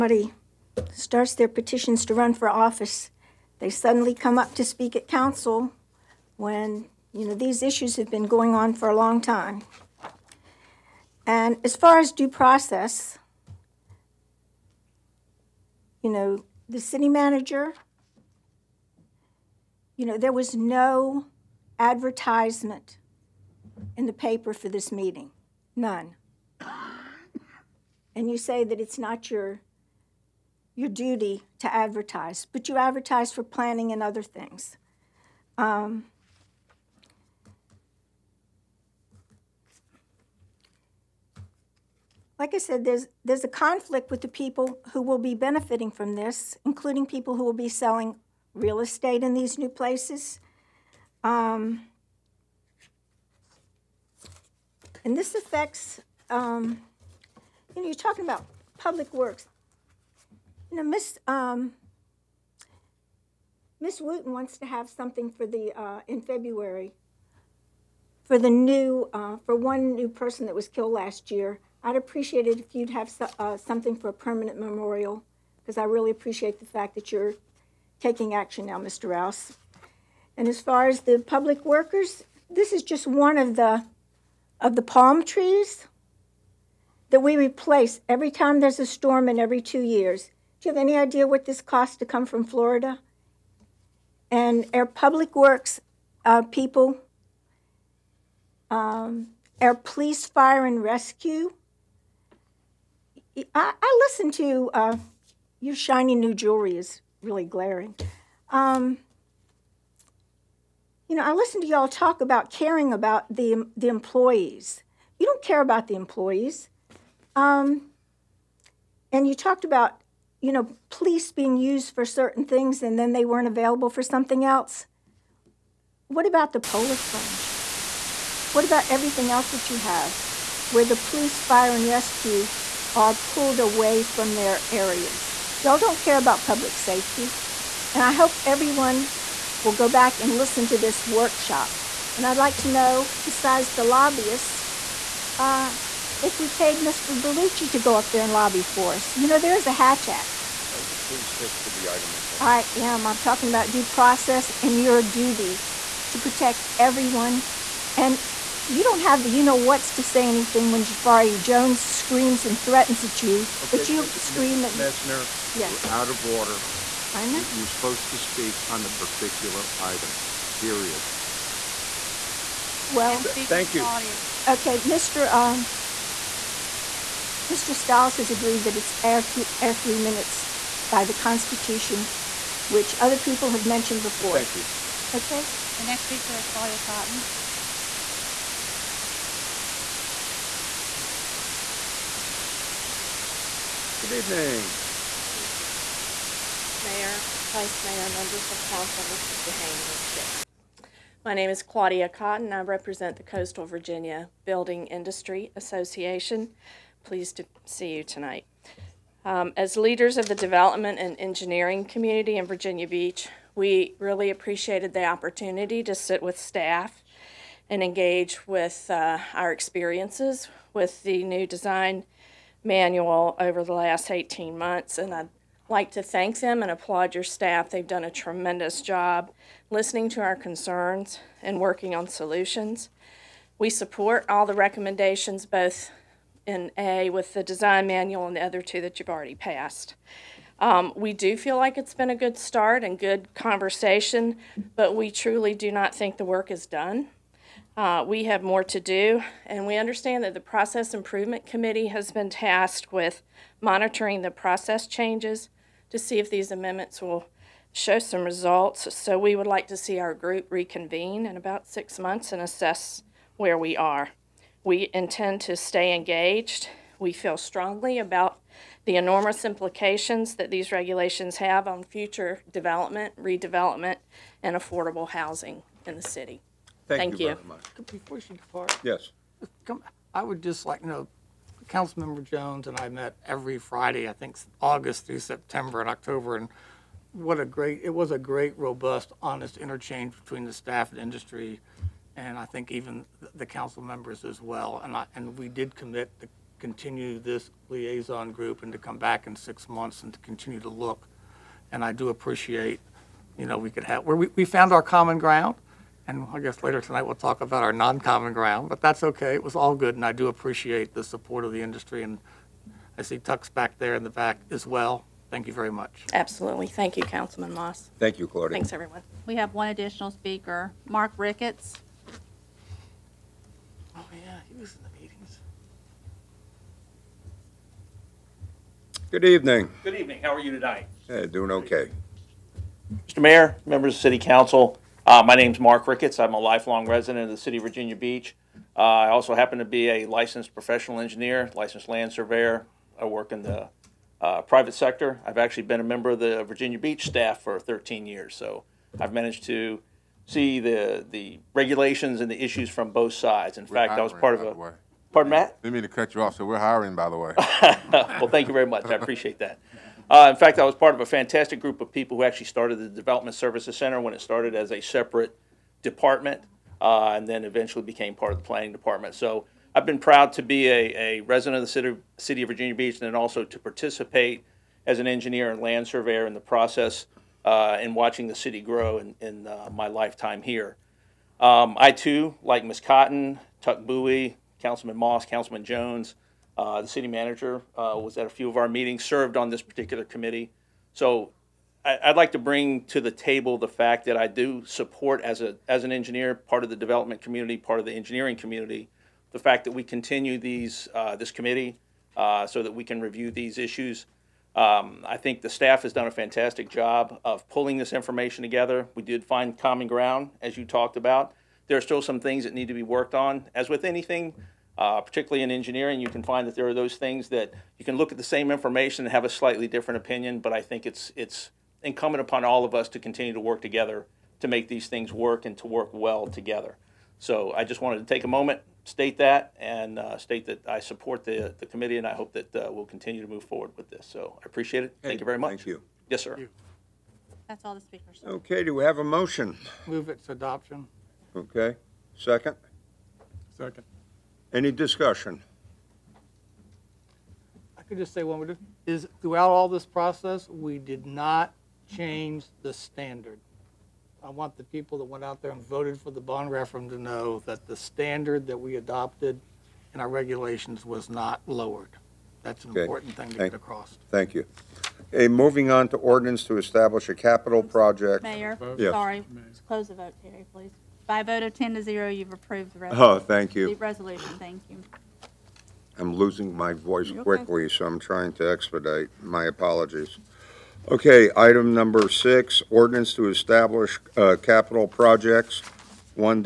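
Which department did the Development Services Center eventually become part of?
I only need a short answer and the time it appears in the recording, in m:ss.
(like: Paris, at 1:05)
Planning Department, at 6:08.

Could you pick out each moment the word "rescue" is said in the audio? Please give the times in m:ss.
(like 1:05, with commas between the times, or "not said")
1:40, 2:11.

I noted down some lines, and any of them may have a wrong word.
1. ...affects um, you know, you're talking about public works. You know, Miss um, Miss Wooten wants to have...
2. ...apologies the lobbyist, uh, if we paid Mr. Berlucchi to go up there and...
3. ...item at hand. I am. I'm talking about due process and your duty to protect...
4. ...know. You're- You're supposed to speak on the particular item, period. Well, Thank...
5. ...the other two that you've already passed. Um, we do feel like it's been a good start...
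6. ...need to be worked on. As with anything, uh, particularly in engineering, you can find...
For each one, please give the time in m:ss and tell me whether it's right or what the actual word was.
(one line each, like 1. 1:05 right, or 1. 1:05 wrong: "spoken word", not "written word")
1. 0:55 right
2. 2:23 wrong: "besides", not "apologies"
3. 2:31 right
4. 2:47 right
5. 3:58 right
6. 6:52 right.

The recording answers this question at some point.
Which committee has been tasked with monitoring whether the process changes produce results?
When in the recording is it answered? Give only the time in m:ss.
4:10.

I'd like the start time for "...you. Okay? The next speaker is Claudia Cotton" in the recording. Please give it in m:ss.
3:04.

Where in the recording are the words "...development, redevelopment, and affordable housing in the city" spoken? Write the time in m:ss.
4:32.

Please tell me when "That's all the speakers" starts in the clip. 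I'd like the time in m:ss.
7:17.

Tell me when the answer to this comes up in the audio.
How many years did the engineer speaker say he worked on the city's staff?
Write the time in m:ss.
5:47.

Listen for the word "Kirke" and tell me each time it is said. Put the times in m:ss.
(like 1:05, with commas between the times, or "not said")
not said.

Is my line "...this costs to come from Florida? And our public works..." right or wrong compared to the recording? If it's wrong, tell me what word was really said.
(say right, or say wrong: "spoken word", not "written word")
right.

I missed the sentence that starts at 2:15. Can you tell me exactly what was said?
Y'all don't care about public safety.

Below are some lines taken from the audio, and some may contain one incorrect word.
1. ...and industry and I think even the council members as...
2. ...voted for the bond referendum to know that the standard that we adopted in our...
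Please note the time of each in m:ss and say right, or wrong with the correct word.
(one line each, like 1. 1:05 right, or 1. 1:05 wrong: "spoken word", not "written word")
1. 4:50 right
2. 7:35 right.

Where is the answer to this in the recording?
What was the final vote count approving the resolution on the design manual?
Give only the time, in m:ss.
7:51.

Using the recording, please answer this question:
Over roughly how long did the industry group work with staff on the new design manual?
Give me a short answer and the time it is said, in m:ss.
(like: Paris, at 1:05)
18 months, at 3:44.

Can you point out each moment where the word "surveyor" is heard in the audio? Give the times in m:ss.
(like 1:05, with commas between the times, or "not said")
5:42, 6:15.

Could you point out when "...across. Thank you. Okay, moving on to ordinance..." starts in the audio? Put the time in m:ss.
7:43.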